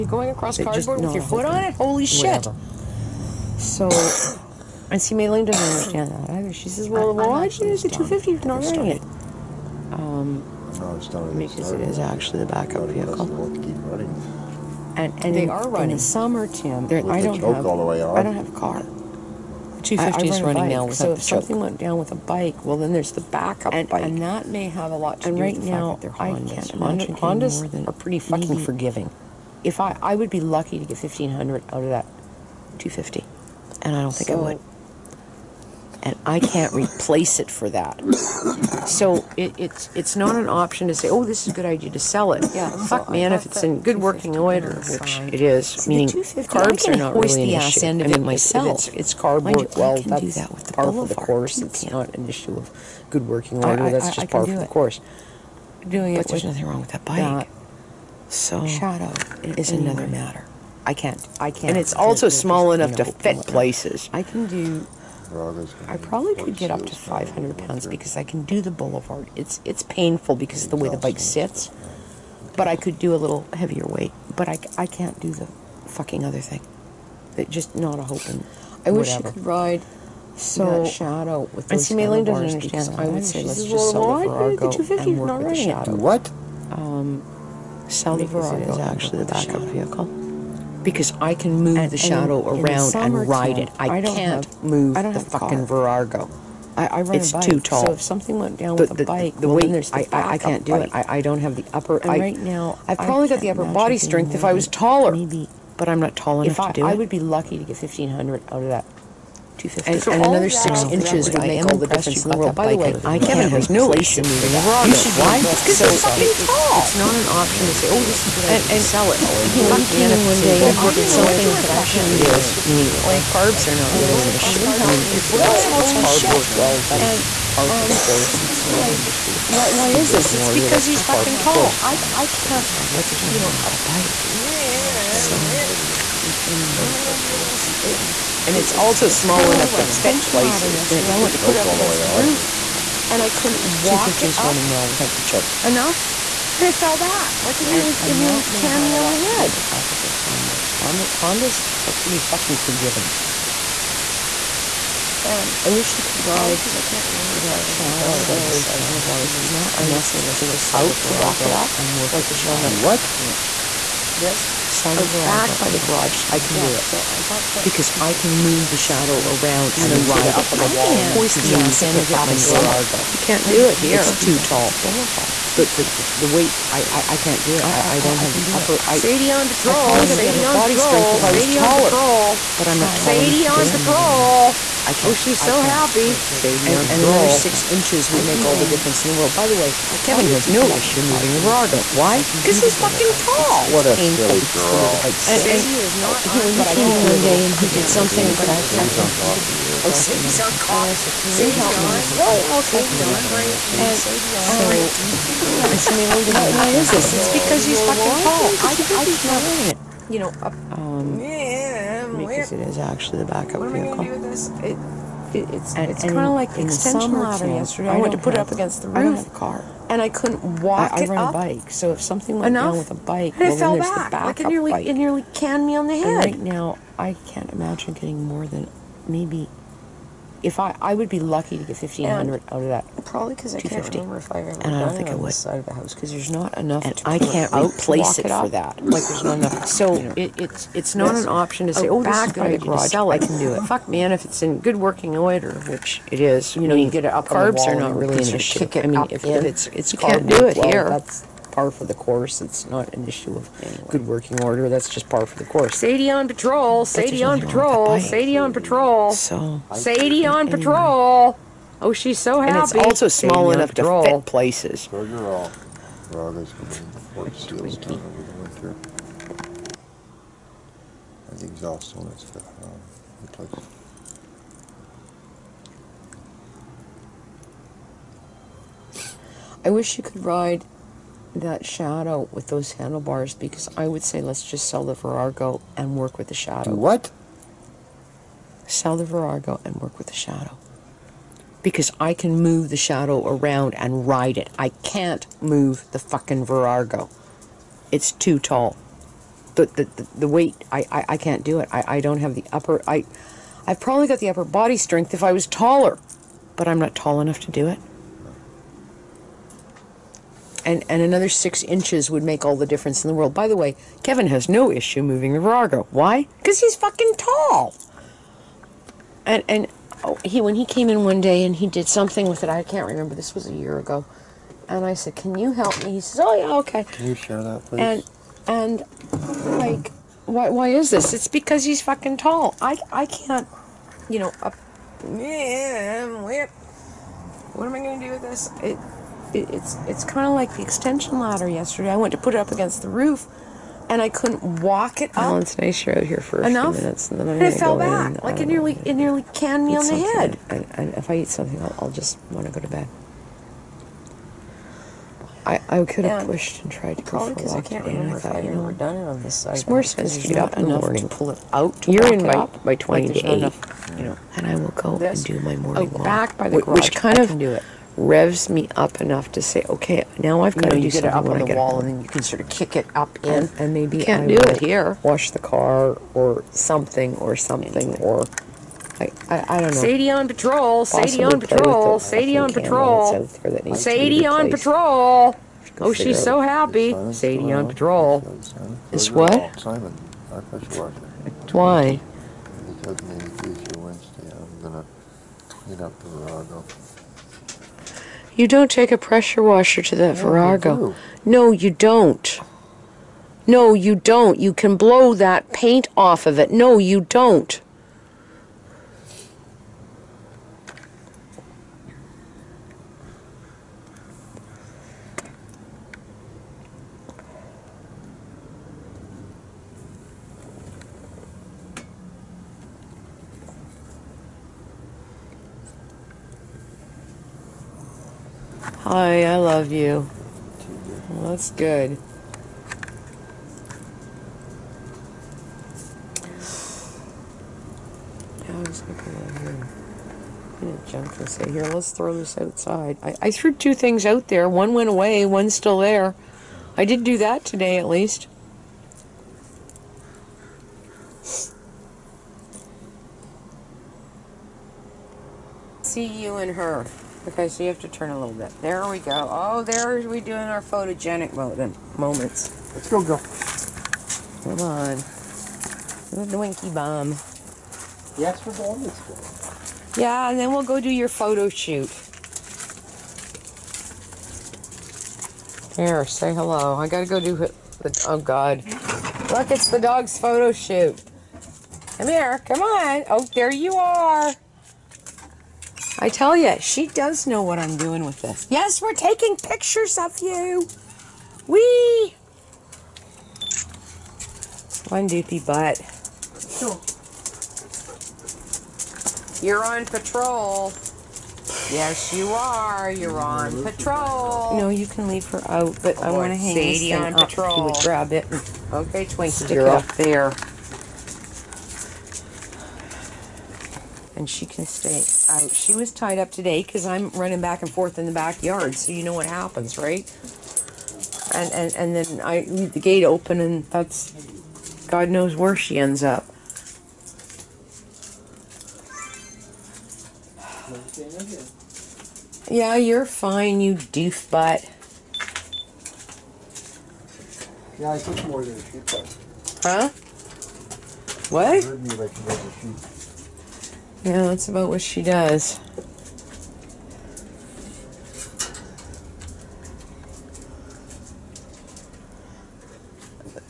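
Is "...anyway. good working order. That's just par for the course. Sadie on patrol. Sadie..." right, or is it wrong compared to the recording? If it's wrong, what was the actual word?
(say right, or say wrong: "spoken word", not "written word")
right.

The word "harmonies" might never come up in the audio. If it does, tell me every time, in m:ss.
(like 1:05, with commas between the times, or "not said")
not said.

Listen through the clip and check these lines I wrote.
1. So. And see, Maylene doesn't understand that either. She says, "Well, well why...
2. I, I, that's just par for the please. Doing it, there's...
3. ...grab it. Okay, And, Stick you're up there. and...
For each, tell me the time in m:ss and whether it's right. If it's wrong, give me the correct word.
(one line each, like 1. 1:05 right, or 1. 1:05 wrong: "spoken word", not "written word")
1. 0:03 right
2. 0:53 wrong: "course", not "please"
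3. 8:27 wrong: "Twinkie", not "And".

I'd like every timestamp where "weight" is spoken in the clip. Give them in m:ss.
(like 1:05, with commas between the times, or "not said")
1:13, 1:39, 2:56, 5:00.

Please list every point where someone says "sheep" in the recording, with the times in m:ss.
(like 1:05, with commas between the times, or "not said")
8:58.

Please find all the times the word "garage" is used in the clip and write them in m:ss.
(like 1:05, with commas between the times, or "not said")
2:45, 4:02, 6:06.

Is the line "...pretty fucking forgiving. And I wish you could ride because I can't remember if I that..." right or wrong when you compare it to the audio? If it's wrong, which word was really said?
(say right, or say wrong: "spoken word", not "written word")
right.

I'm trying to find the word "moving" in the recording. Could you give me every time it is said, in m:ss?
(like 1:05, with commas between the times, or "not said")
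1:54, 3:11, 5:15.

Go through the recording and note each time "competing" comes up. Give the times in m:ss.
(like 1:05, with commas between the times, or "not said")
not said.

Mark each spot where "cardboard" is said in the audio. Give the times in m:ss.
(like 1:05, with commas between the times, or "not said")
0:00, 0:49, 2:05.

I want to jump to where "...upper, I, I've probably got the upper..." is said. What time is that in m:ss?
5:02.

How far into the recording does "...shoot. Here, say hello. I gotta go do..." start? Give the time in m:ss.
7:51.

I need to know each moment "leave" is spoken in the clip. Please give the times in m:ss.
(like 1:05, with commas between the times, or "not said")
8:25, 8:42.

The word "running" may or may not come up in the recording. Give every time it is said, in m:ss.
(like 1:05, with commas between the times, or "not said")
0:08, 0:15, 0:20, 2:24, 8:37.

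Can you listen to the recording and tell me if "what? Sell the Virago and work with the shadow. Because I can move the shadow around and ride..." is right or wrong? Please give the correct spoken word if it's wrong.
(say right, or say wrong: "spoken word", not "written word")
right.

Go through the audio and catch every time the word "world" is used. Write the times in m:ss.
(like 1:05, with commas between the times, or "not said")
1:52, 3:09, 5:13.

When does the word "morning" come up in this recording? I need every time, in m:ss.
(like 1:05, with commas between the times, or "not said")
6:00, 6:05.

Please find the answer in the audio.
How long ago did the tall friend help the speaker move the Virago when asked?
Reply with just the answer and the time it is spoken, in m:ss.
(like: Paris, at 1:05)
a year ago, at 5:23.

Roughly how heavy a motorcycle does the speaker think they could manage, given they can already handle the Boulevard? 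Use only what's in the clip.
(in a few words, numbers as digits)
500 pounds.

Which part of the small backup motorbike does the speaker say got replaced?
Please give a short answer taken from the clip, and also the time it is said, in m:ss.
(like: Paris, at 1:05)
exhaust, at 4:31.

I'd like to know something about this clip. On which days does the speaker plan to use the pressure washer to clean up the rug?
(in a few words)
Tuesday, Wednesday.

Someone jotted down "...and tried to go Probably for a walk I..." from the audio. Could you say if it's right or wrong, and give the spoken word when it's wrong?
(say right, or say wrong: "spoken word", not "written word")
right.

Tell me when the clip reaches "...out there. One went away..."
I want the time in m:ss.
7:24.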